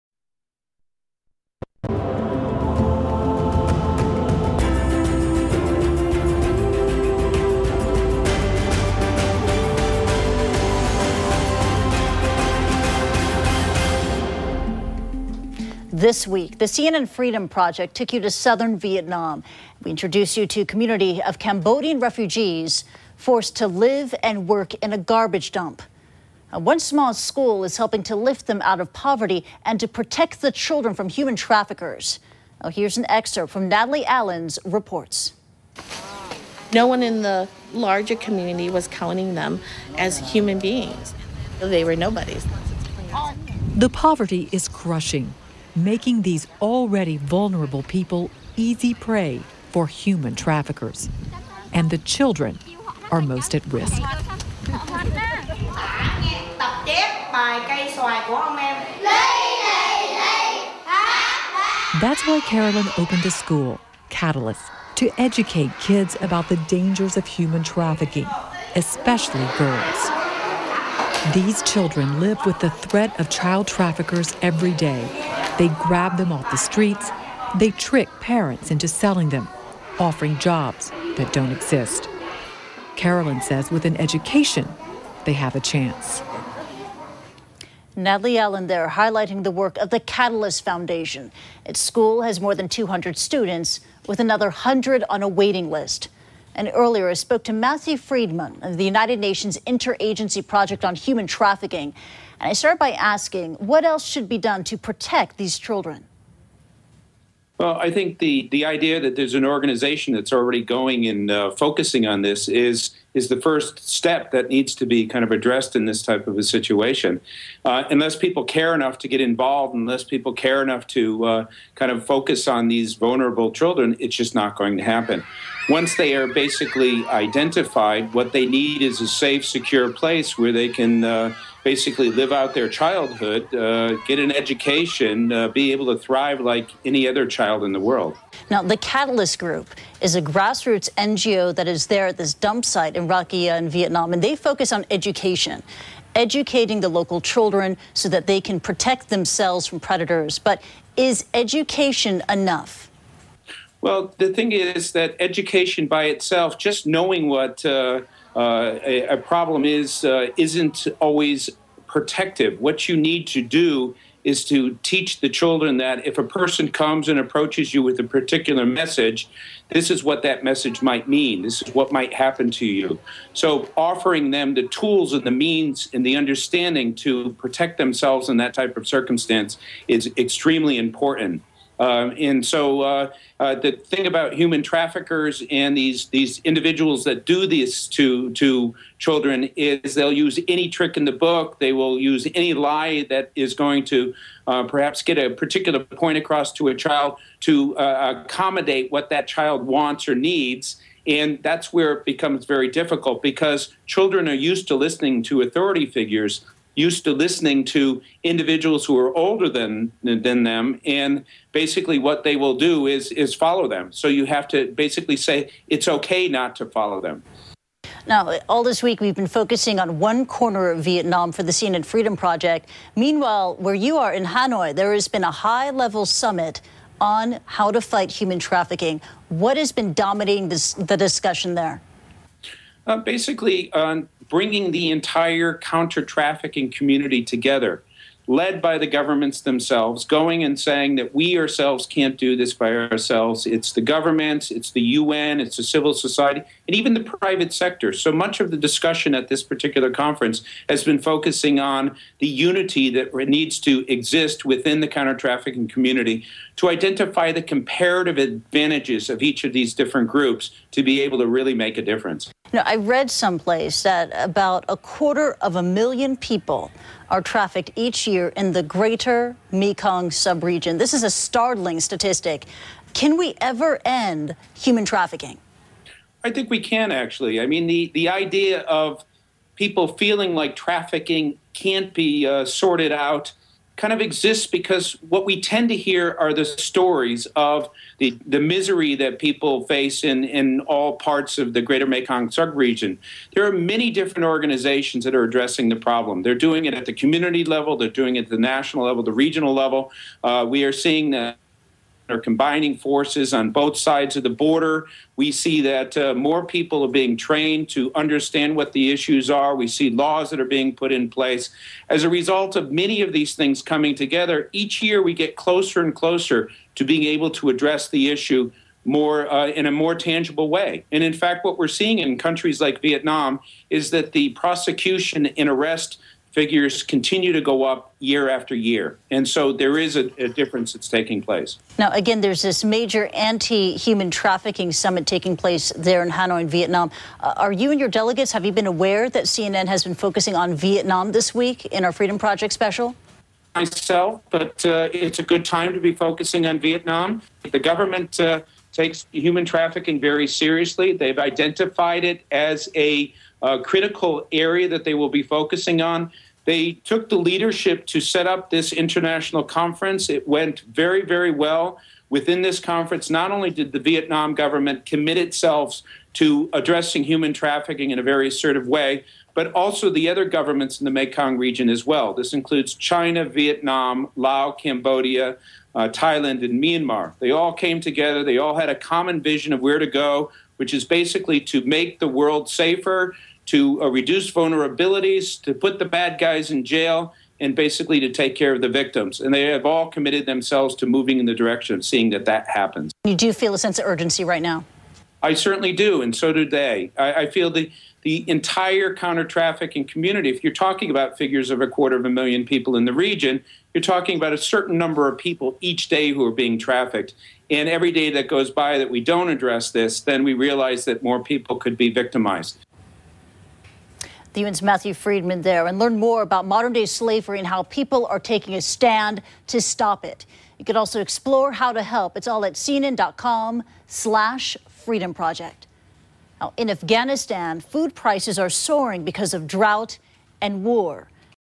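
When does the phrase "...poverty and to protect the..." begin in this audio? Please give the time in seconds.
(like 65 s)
28 s.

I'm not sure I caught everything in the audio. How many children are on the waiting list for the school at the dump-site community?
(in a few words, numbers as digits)
100.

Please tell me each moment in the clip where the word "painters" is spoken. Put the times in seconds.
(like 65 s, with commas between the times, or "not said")
not said.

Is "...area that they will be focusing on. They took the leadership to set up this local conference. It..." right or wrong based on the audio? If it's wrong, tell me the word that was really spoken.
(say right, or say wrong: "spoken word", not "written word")
wrong: "international", not "local".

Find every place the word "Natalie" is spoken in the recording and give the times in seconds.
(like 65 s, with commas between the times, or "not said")
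33 s, 87 s.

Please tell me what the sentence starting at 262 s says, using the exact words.
Now I read someplace that about a quarter of a million people are trafficked each year in the greater Mekong subregion.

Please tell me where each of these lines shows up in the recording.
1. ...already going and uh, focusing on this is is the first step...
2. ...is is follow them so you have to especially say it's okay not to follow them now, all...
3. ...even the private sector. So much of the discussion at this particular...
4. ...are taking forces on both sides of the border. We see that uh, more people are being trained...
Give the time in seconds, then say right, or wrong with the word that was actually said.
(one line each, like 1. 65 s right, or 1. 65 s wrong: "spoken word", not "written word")
1. 110 s right
2. 212 s wrong: "basically", not "especially"
3. 246 s right
4. 302 s wrong: "combining", not "taking".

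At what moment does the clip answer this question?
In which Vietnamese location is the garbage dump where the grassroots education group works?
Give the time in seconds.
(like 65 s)
143 s.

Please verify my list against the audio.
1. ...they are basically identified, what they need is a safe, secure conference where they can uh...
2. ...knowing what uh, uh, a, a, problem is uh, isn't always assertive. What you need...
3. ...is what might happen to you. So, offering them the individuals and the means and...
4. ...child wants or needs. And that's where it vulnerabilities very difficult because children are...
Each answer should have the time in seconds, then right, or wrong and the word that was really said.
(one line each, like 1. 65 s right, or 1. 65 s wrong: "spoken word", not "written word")
1. 125 s wrong: "place", not "conference"
2. 156 s wrong: "protective", not "assertive"
3. 171 s wrong: "tools", not "individuals"
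4. 199 s wrong: "becomes", not "vulnerabilities".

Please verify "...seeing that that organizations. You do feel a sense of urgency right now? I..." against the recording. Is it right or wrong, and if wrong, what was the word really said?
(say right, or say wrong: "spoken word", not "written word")
wrong: "happens", not "organizations".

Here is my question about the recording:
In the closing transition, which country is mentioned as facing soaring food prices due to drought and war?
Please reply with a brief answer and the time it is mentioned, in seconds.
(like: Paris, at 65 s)
Afghanistan, at 426 s.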